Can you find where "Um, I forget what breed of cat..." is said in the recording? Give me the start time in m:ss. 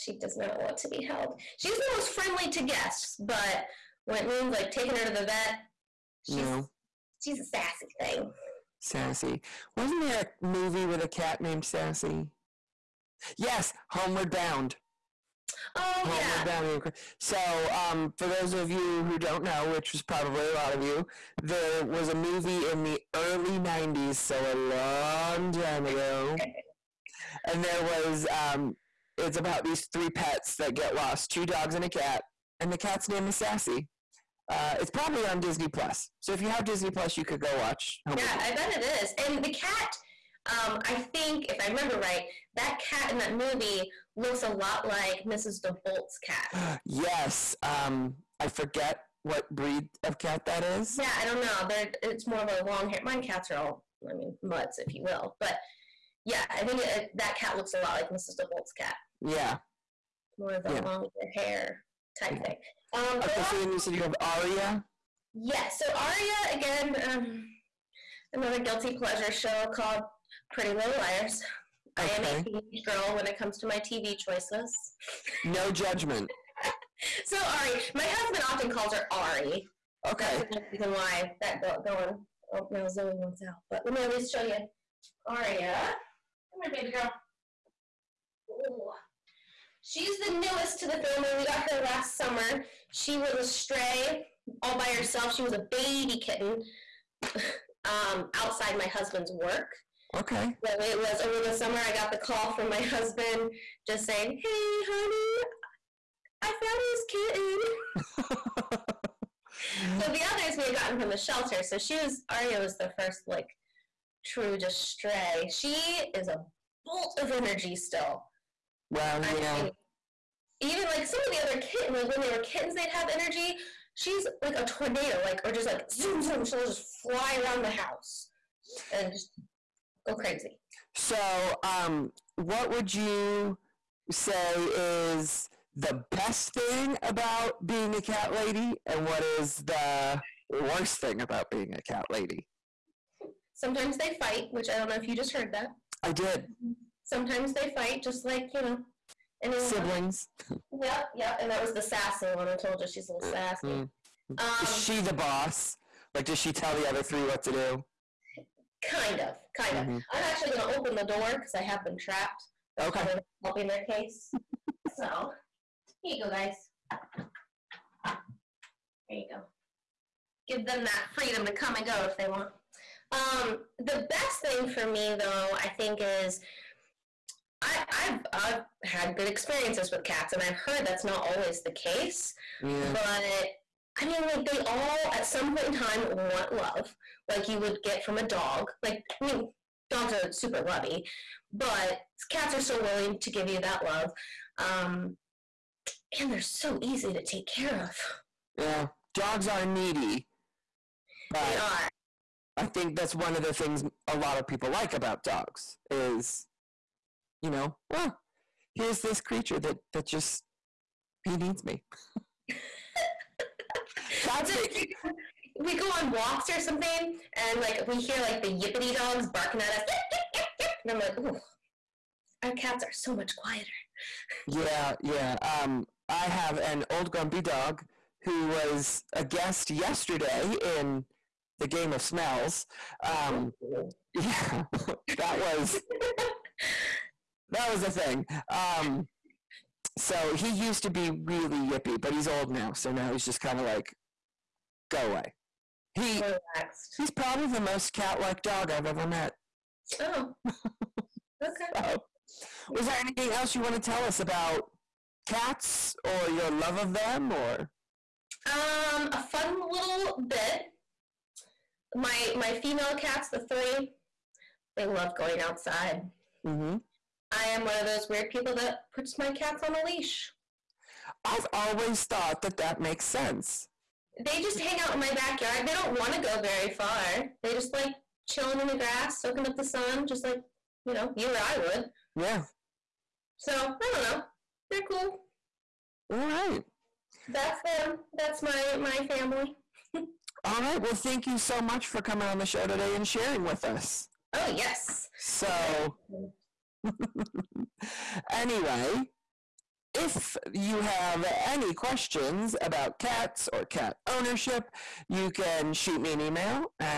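0:47.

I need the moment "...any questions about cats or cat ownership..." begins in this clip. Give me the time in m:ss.
5:01.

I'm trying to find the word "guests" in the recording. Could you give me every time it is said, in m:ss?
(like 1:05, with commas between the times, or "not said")
0:02, 3:49.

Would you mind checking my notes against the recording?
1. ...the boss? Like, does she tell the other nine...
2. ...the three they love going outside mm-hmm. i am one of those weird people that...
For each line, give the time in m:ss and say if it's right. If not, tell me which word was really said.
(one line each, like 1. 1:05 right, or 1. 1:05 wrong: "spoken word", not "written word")
1. 2:34 wrong: "three", not "nine"
2. 4:23 right.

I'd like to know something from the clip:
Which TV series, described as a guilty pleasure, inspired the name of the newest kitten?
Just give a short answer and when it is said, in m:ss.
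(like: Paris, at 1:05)
Pretty Little Liars, at 1:10.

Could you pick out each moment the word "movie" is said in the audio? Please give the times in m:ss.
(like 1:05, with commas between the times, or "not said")
0:10, 0:22, 0:43.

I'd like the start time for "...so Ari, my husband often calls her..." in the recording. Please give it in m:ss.
1:17.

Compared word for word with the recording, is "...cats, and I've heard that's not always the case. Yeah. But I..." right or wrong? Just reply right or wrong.
right.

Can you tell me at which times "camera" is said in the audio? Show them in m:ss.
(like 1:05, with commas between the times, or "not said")
not said.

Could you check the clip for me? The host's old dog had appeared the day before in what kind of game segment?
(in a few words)
game of smells.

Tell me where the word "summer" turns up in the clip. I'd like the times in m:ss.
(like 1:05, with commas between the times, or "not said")
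1:32, 1:41.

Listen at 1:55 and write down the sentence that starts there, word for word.
She is a bolt of energy still.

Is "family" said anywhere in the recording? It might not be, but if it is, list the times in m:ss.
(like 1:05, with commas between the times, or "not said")
1:30, 4:49.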